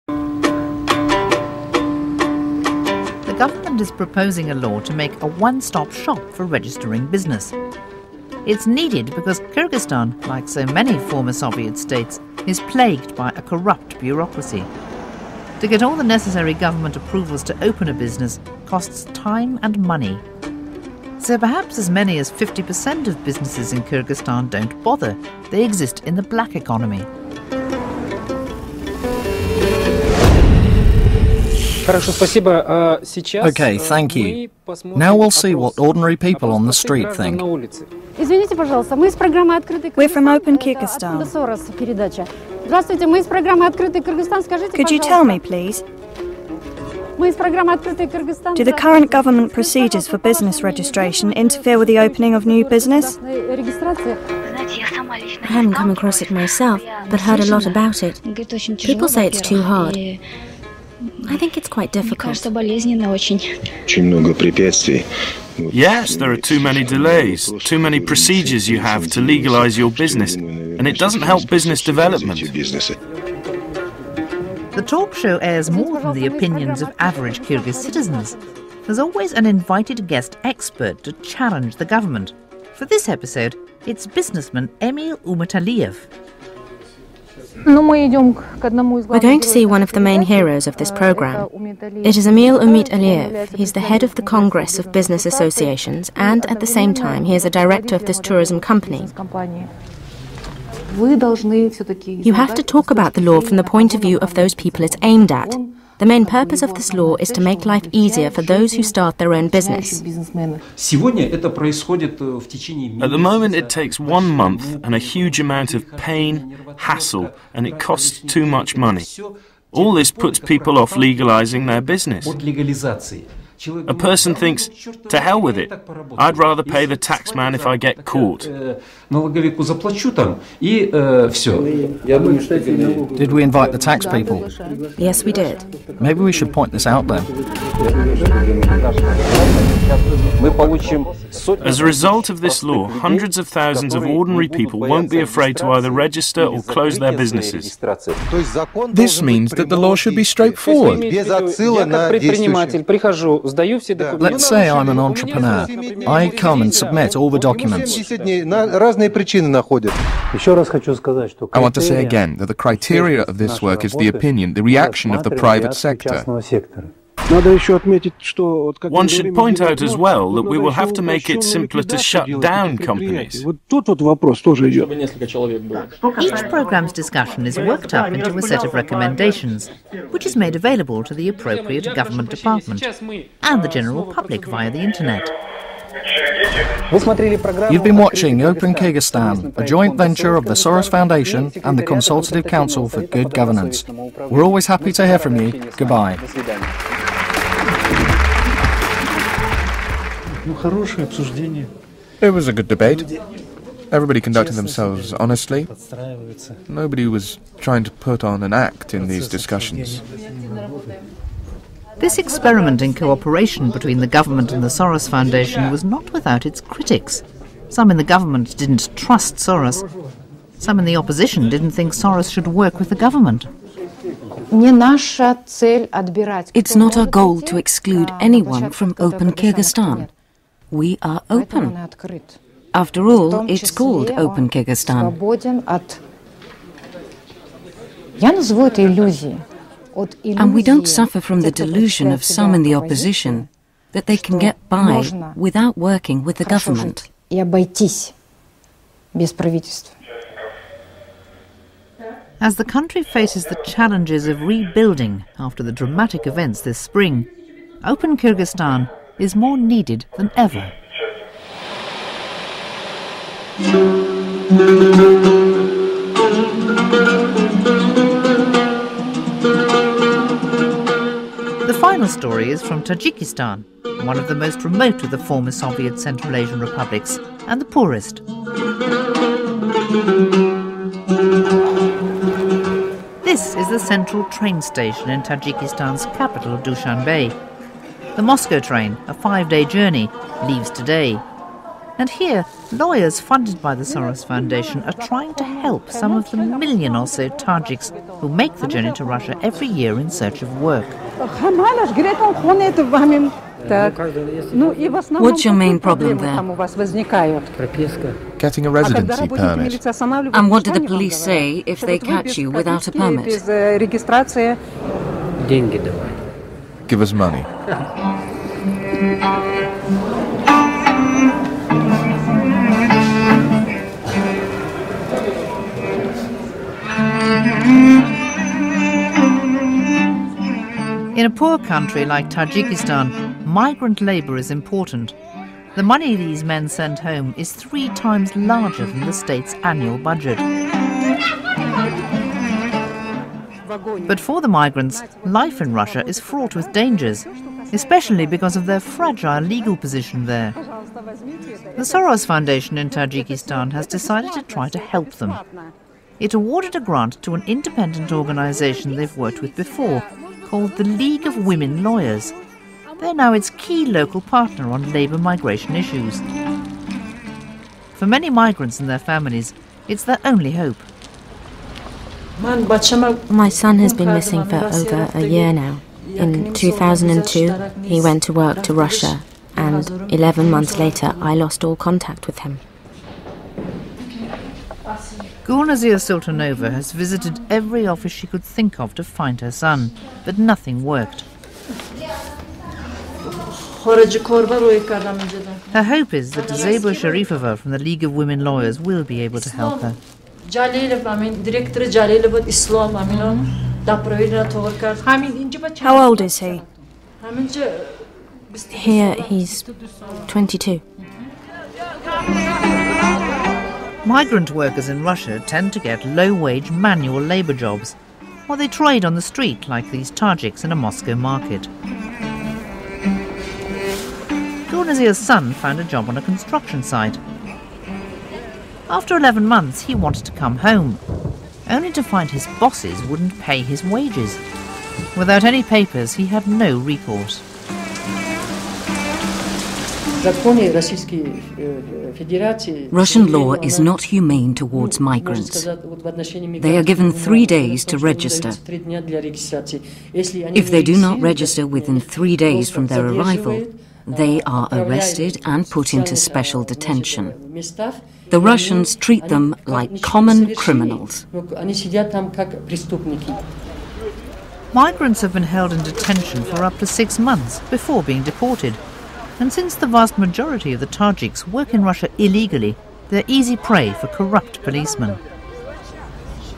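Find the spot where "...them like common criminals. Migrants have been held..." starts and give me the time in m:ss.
7:39.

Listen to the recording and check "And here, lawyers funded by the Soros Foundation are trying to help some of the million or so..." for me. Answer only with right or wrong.
right.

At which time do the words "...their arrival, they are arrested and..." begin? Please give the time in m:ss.
7:32.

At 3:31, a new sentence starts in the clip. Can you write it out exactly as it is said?
This experiment in cooperation between the government and the Soros Foundation was not without its critics.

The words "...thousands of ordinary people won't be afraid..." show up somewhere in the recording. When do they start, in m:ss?
2:23.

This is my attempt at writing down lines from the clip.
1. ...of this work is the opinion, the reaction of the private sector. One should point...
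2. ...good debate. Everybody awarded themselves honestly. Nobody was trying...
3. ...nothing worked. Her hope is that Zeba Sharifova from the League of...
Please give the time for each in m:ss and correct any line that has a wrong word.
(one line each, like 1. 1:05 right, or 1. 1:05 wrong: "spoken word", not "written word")
1. 2:43 right
2. 3:22 wrong: "conducted", not "awarded"
3. 6:30 right.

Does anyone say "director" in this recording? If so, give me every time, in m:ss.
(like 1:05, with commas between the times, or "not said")
1:37.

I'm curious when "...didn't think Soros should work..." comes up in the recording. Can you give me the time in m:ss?
3:41.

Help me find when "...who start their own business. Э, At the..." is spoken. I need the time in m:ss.
1:48.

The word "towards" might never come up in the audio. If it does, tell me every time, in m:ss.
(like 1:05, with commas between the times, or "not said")
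7:24.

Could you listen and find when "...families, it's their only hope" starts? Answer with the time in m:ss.
6:08.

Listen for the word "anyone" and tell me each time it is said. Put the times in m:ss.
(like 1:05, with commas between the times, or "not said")
3:48.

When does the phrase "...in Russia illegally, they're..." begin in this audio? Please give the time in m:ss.
7:51.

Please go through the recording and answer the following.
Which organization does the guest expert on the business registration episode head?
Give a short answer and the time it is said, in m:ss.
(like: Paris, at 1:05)
Congress of Business Associations, at 1:34.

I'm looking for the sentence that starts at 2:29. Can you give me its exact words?
This means that the law should be straightforward.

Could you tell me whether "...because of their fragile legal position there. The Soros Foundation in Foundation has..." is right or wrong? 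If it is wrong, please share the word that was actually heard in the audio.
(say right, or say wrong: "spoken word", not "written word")
wrong: "Tajikistan", not "Foundation".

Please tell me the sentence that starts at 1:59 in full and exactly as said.
All this puts people off legalizing their business.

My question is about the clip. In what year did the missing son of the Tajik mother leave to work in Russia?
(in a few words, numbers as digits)
2002.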